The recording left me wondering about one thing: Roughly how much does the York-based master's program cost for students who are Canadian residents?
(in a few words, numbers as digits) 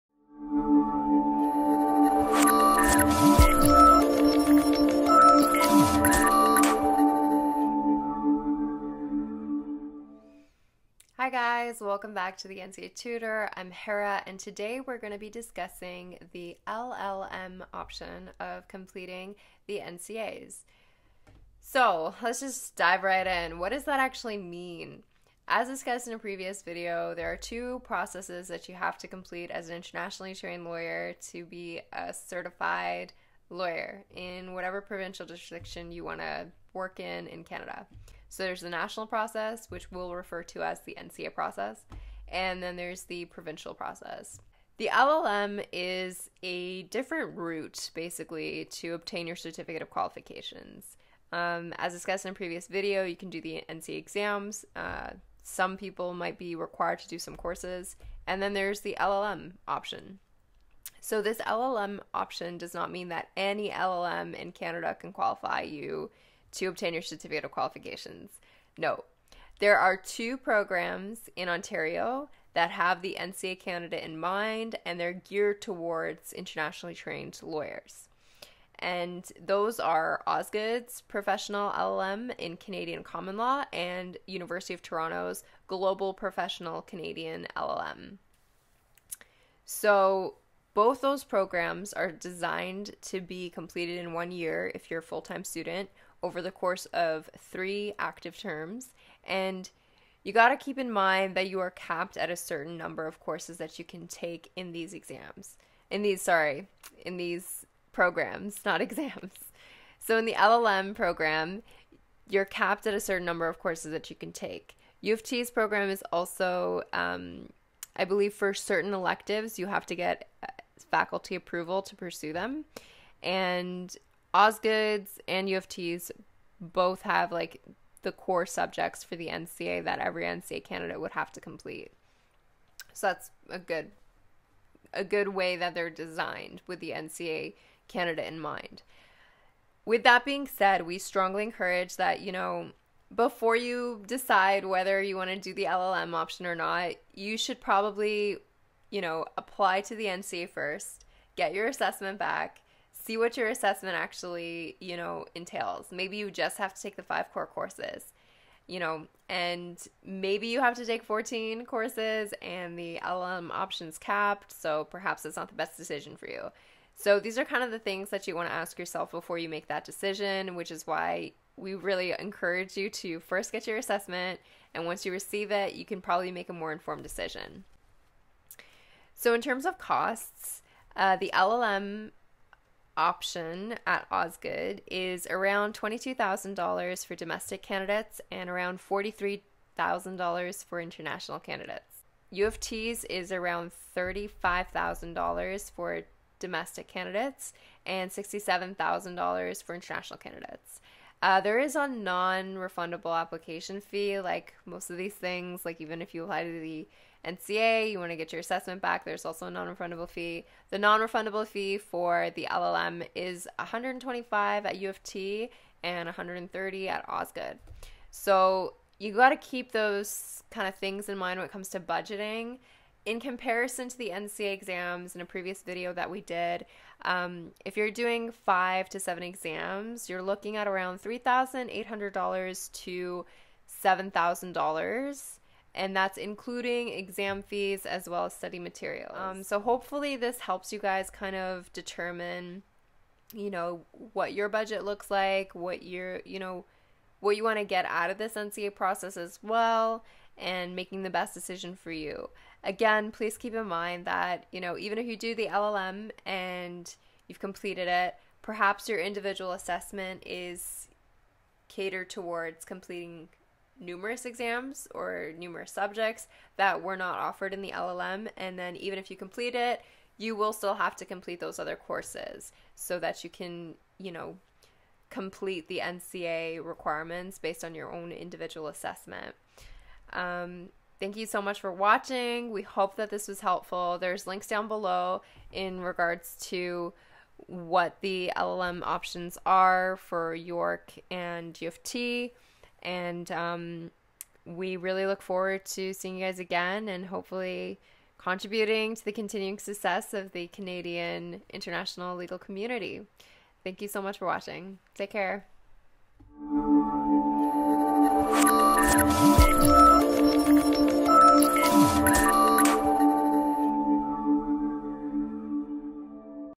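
$22,000.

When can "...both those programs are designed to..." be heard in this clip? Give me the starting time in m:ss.
1:30.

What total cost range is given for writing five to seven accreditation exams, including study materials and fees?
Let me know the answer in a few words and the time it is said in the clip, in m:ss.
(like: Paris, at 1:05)
$3,800 to $7,000, at 3:51.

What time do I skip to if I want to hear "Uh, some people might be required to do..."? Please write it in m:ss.
0:54.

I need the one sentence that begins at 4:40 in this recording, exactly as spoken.
Um, thank you so much for watching.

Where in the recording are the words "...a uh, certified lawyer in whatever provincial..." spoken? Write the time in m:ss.
0:31.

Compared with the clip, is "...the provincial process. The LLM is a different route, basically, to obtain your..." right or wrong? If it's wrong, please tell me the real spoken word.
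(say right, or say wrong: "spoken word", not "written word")
right.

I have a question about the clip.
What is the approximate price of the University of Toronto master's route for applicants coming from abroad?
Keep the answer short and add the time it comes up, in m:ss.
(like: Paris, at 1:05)
$67,000, at 3:18.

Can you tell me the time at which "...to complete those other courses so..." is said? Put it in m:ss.
4:30.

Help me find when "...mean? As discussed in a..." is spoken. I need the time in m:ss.
0:24.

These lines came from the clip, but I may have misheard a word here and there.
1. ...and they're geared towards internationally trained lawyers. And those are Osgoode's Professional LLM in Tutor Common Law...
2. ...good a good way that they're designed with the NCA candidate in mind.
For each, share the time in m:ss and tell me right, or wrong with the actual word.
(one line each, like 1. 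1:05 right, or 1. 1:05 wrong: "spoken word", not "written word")
1. 1:14 wrong: "Canadian", not "Tutor"
2. 2:13 right.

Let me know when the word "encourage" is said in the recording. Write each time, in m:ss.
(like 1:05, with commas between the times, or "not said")
2:21, 2:52.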